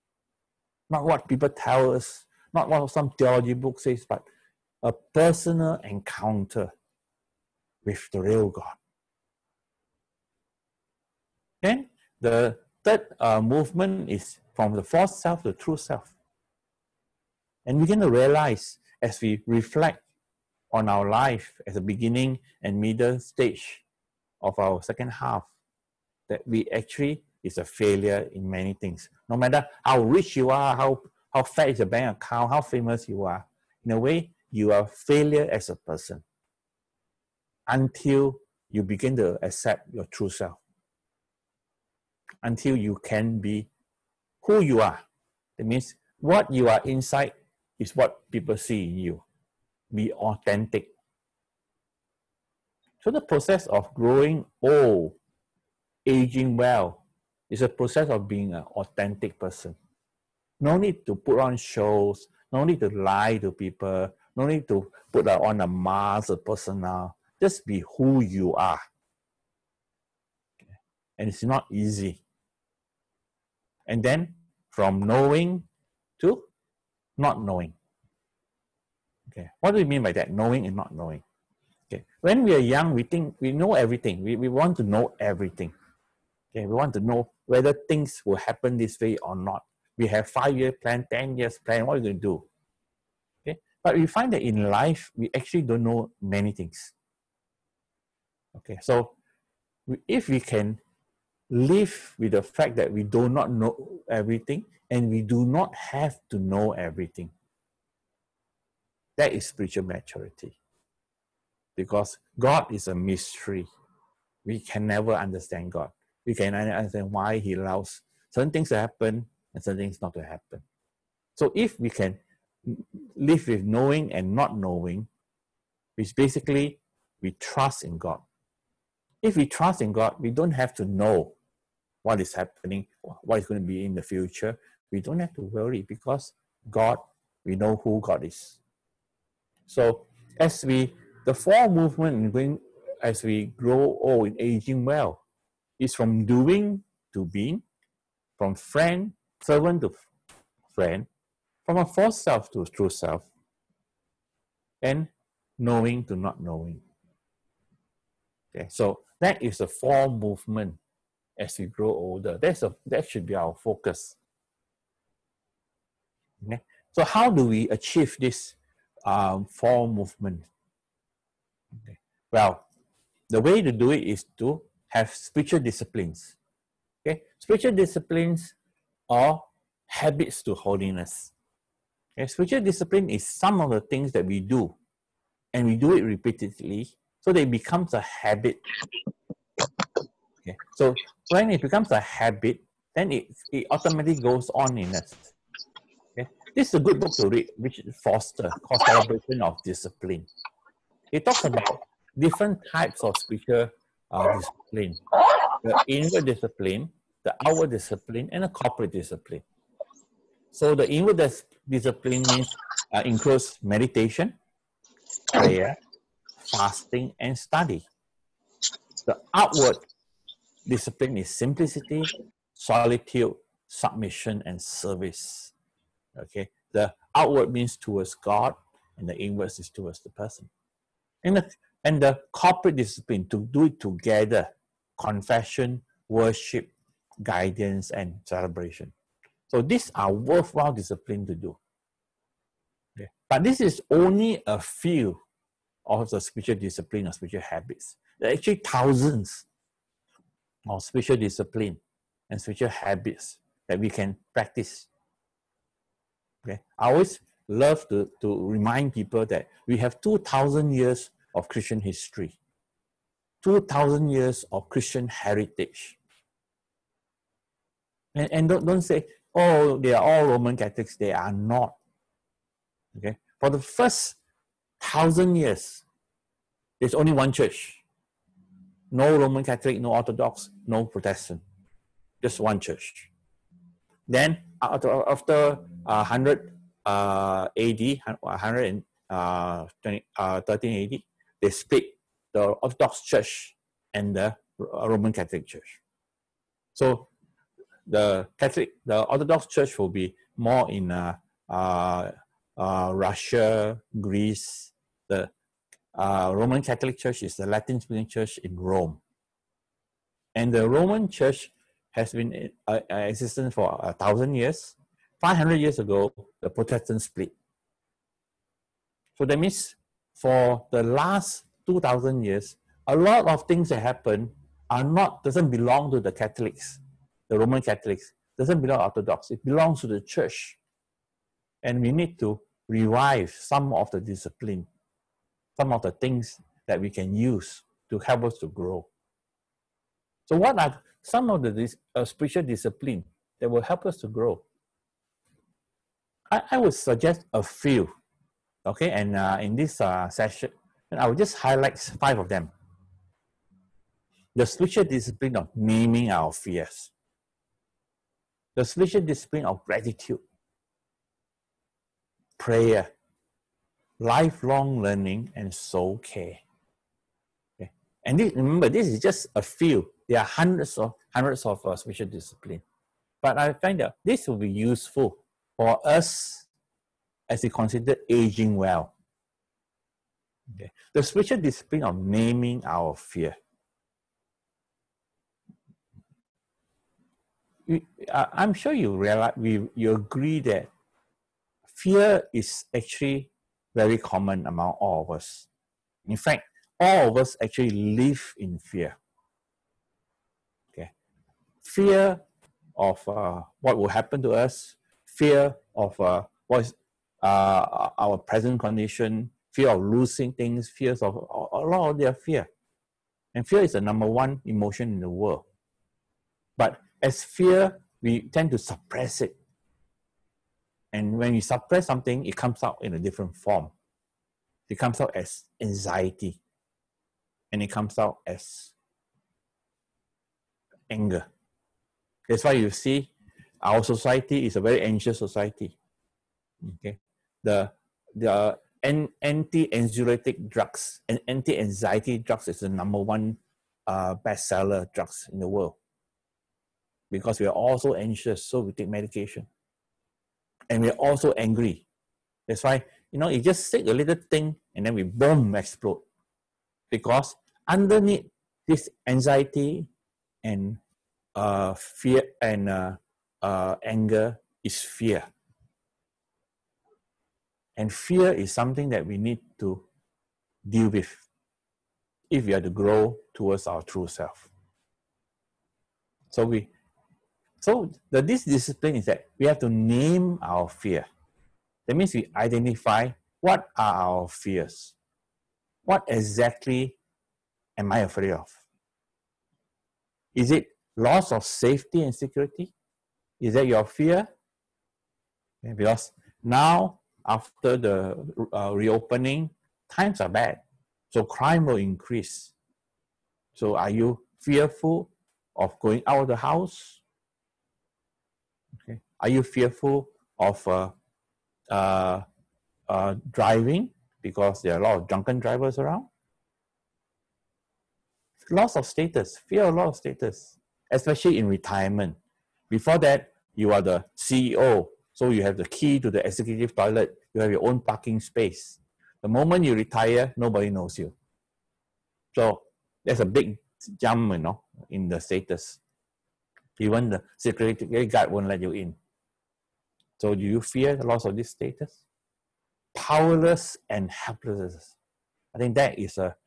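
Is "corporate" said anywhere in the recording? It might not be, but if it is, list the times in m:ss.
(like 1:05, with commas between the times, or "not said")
3:28, 3:52.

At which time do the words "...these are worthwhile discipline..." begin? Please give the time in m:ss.
3:59.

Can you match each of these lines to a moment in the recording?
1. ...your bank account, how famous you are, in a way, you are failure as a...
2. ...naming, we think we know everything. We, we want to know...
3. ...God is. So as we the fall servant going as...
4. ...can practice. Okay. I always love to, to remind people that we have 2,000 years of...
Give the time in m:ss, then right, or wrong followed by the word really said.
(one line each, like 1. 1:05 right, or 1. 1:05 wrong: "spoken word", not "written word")
1. 0:31 right
2. 1:22 wrong: "young", not "naming"
3. 2:17 wrong: "movement", not "servant"
4. 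4:13 right.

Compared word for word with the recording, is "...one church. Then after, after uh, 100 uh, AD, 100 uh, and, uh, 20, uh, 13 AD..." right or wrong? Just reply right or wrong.
right.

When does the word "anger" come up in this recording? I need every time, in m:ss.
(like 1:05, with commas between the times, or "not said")
7:10, 7:43.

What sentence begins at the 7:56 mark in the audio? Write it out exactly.
So we so the, this discipline is that we have to name our fear.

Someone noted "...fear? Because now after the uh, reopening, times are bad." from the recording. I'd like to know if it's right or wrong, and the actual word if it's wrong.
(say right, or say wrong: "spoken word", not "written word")
right.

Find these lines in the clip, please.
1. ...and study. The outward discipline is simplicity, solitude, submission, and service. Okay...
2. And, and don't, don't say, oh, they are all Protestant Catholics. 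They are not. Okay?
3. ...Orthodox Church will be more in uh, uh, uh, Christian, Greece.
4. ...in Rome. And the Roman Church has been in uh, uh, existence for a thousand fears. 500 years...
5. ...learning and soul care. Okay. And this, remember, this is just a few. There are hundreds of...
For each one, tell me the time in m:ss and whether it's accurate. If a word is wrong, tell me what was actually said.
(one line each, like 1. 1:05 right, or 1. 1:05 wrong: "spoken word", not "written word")
1. 3:37 right
2. 4:28 wrong: "Roman", not "Protestant"
3. 4:59 wrong: "Russia", not "Christian"
4. 5:08 wrong: "years", not "fears"
5. 6:04 right.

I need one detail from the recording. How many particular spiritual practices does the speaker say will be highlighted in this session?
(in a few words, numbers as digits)
5.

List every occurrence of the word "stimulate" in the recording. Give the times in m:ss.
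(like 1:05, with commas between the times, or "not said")
not said.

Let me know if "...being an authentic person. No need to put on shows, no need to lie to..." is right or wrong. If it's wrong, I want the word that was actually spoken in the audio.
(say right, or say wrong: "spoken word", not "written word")
right.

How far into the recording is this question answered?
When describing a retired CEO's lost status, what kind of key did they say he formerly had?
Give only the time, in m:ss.
8:46.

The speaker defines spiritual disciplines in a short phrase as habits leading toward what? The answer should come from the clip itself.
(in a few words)
holiness.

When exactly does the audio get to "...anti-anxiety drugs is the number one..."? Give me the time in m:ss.
7:21.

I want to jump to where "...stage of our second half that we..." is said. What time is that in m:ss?
0:23.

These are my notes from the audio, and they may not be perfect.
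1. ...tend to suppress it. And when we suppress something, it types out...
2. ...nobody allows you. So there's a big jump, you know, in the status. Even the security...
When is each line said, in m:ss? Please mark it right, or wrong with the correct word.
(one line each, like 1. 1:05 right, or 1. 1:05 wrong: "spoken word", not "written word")
1. 6:58 wrong: "comes", not "types"
2. 8:50 wrong: "knows", not "allows".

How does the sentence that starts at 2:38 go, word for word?
Okay, so that is a four movement as we grow older.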